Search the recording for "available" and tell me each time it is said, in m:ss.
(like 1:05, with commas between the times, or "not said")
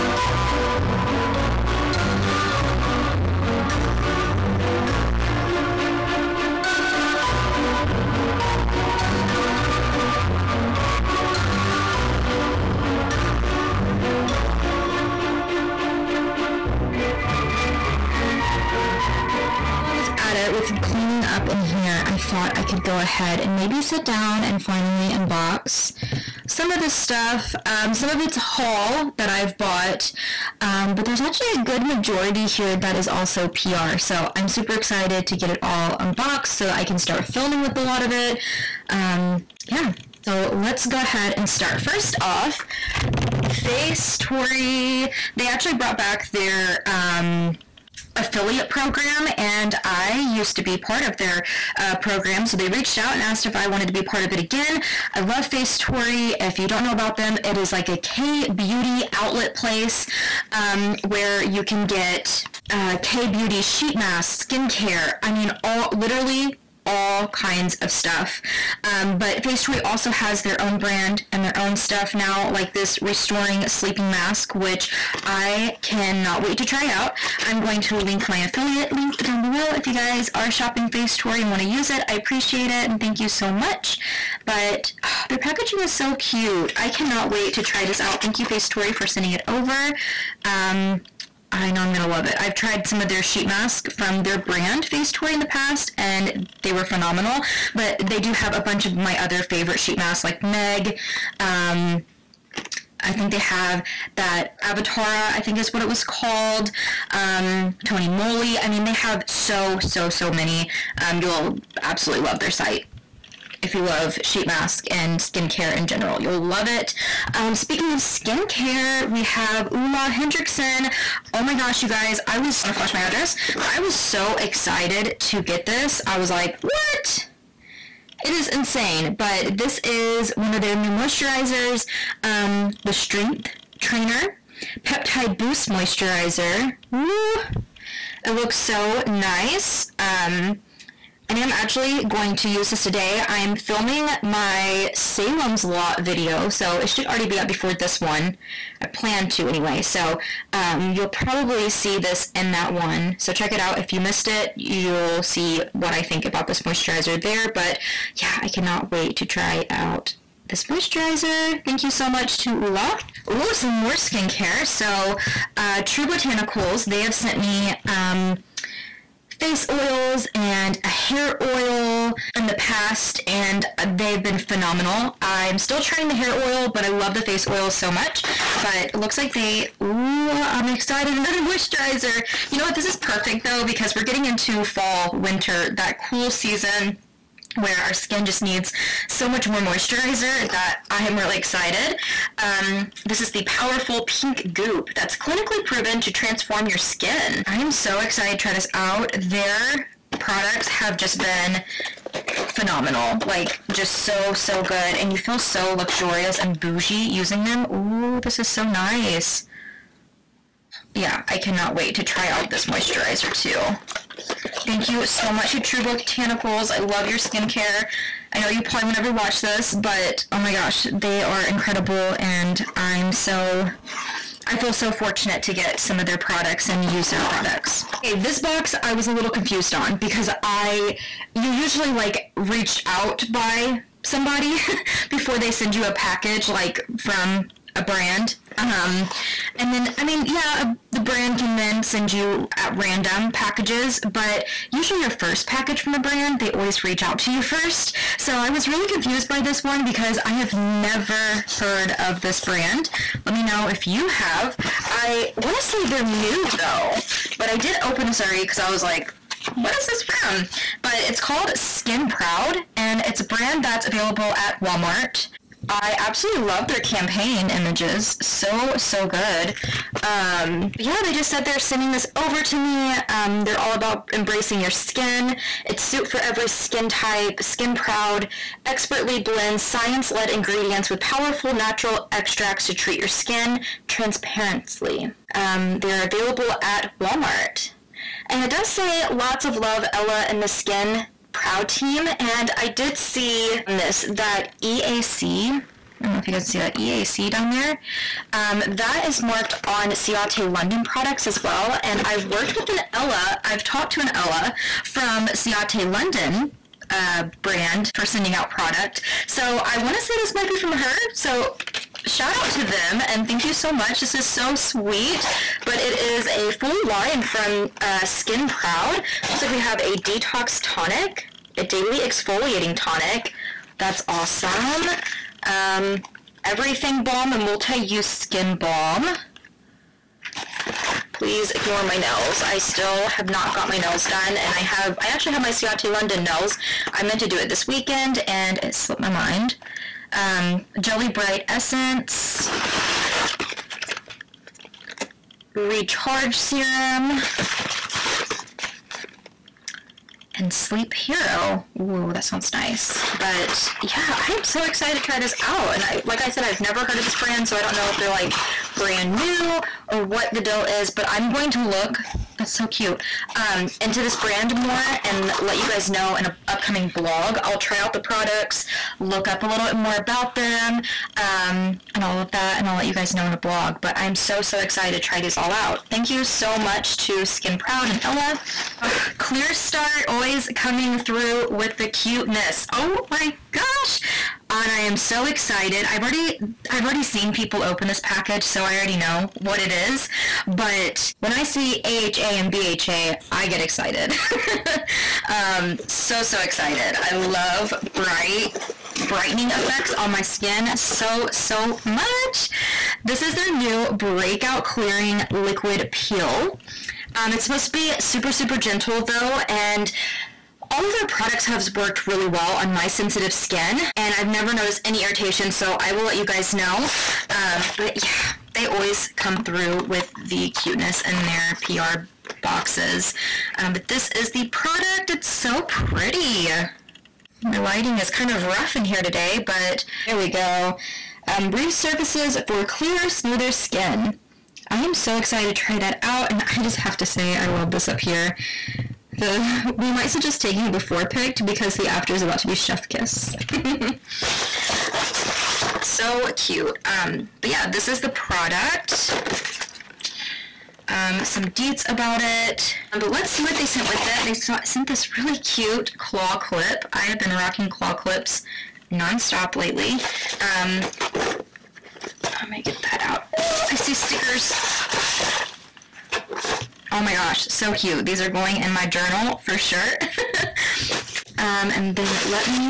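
4:23, 4:46.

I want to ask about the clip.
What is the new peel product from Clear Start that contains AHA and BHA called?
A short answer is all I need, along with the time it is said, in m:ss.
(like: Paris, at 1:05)
Breakout Clearing Liquid Peel, at 6:43.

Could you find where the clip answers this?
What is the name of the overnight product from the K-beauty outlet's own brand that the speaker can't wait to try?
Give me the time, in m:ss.
1:13.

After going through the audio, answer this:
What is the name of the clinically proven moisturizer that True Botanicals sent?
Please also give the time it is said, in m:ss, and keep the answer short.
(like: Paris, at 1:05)
Powerful Pink Goop, at 3:13.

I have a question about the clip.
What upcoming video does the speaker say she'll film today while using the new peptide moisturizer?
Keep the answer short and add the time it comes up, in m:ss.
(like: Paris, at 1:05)
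Salem's Lot, at 2:24.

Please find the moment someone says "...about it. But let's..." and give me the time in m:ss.
7:31.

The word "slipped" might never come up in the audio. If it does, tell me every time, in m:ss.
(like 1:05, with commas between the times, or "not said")
5:38.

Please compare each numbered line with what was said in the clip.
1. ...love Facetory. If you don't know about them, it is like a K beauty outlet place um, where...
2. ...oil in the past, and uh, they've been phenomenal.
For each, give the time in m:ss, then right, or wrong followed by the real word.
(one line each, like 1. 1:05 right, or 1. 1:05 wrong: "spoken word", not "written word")
1. 0:55 right
2. 2:51 right.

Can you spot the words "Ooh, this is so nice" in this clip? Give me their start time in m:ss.
3:27.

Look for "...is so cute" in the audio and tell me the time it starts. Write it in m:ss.
1:25.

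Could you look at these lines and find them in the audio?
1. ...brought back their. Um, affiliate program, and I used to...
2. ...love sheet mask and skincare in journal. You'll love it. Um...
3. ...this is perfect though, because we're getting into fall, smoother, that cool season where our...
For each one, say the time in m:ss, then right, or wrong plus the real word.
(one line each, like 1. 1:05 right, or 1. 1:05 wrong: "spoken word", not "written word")
1. 0:45 right
2. 1:53 wrong: "general", not "journal"
3. 3:02 wrong: "winter", not "smoother".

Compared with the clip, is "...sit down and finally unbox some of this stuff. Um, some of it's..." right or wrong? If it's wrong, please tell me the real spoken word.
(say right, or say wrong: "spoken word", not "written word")
right.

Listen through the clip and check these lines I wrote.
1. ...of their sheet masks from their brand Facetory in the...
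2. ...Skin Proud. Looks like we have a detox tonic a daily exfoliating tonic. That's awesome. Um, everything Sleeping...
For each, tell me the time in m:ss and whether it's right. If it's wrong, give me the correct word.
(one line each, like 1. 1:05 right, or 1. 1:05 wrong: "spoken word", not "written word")
1. 1:33 right
2. 5:18 wrong: "Balm", not "Sleeping".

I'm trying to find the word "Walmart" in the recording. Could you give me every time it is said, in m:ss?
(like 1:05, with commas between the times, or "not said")
4:24, 4:46.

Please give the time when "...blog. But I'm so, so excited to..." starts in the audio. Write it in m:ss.
6:13.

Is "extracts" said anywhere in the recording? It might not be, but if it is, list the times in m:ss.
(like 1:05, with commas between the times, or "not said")
4:42.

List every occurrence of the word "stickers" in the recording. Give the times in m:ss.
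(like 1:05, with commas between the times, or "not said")
7:43.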